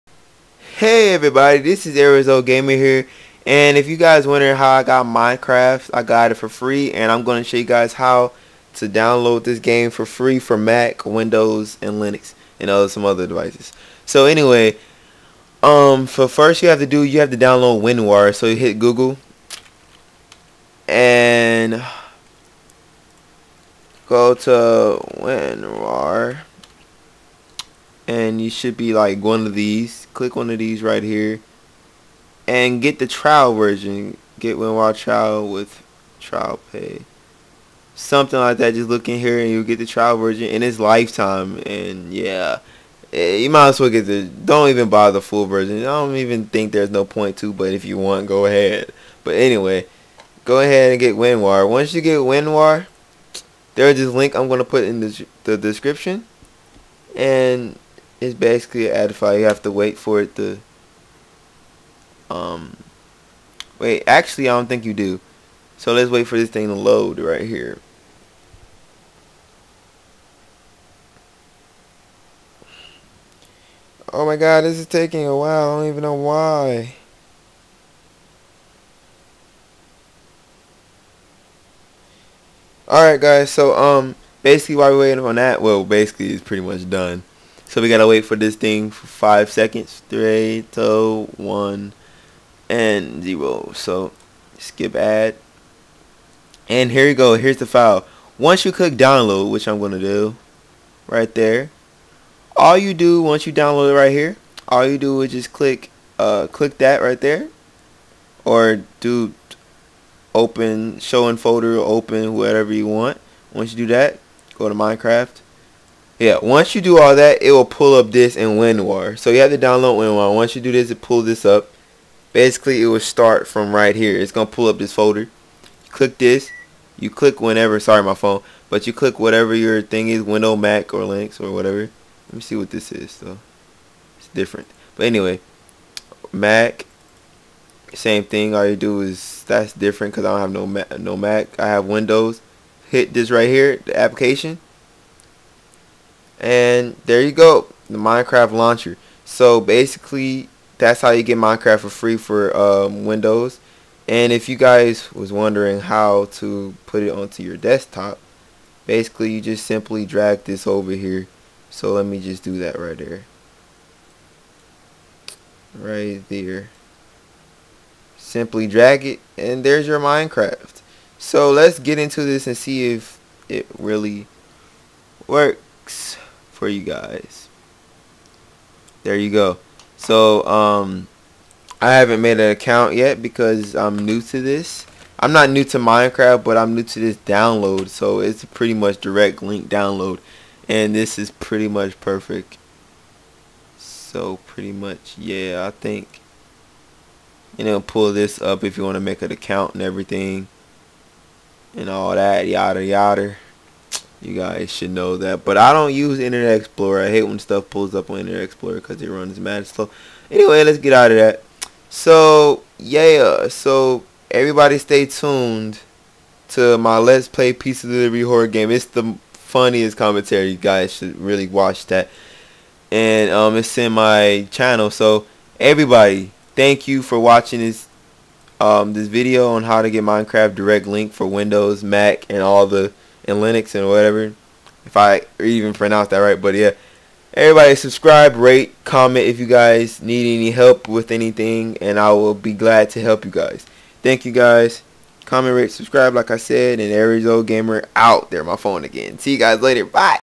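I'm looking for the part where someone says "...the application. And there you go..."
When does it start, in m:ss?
2:23.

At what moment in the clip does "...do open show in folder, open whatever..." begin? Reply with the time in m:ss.
1:48.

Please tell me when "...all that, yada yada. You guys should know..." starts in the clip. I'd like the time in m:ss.
3:21.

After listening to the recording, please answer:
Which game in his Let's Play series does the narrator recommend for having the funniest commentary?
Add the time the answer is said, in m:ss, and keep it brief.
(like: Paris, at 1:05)
Pizza Delivery Horror Game, at 3:37.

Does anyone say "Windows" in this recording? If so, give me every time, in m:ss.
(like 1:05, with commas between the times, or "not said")
0:11, 2:10, 2:21, 2:33, 3:51.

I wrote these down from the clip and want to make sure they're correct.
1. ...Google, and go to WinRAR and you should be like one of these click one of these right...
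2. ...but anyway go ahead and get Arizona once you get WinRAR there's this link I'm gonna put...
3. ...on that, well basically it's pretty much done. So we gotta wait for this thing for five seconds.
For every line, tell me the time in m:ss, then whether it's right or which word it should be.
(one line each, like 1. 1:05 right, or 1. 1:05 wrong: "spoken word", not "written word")
1. 0:18 right
2. 0:49 wrong: "WinRAR", not "Arizona"
3. 1:25 right.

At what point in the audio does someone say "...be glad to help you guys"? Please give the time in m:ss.
4:02.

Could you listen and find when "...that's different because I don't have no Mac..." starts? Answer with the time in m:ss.
2:19.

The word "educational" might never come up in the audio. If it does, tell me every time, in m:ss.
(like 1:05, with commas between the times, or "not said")
not said.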